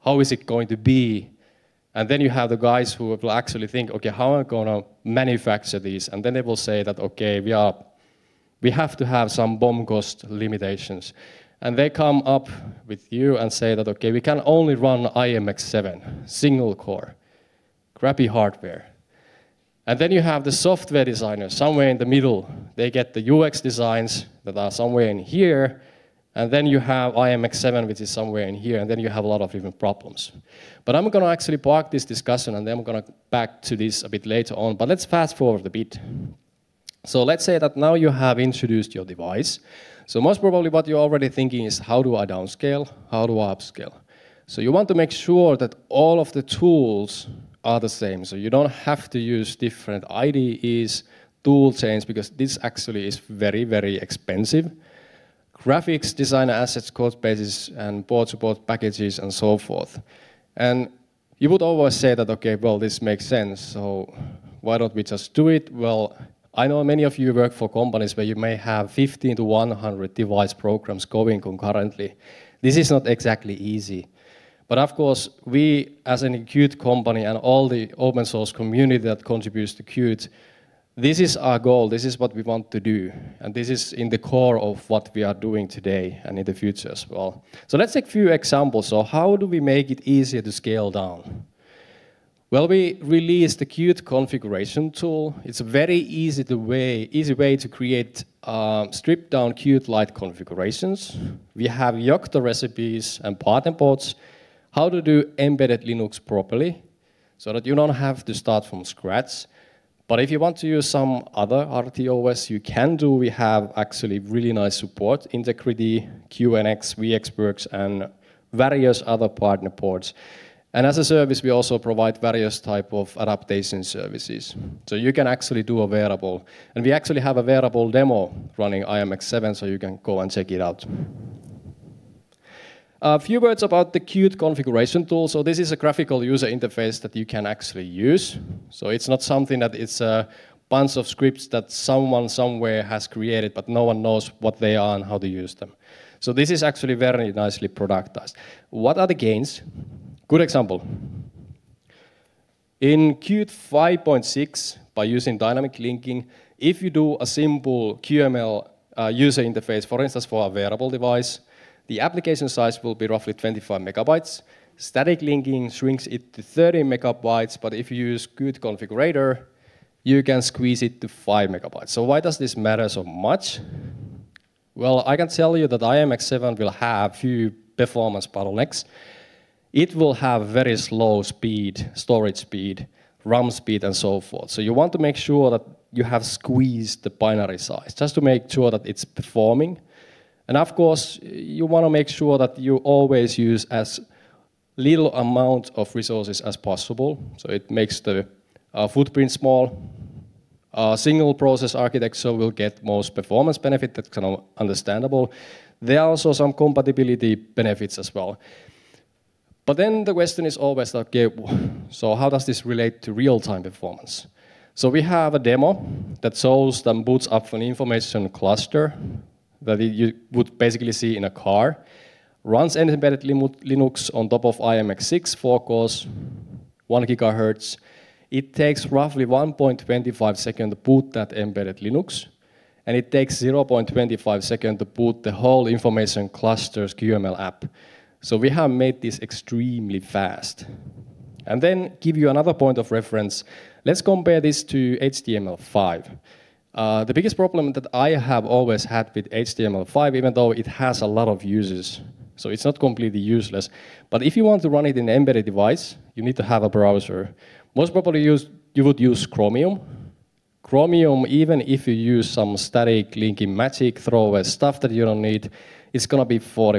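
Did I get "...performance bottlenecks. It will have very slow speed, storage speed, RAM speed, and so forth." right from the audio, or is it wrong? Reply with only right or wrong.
right.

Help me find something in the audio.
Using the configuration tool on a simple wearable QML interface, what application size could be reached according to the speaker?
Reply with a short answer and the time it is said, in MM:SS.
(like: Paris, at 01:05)
5 megabytes, at 02:51.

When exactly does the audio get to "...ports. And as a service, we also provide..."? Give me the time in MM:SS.
01:59.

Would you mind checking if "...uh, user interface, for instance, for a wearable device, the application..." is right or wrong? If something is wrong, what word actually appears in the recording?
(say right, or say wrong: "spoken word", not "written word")
right.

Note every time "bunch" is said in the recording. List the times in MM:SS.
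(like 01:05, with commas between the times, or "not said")
02:20.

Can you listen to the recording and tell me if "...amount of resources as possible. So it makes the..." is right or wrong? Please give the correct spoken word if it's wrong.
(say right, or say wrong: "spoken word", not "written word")
right.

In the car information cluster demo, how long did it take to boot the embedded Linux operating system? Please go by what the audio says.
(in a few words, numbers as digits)
1.25 seconds.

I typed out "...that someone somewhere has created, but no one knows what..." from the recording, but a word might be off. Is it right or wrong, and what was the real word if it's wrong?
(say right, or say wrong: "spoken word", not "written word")
right.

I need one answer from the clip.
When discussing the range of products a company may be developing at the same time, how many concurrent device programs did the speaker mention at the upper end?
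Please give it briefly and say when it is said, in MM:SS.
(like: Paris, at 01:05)
100, at 01:09.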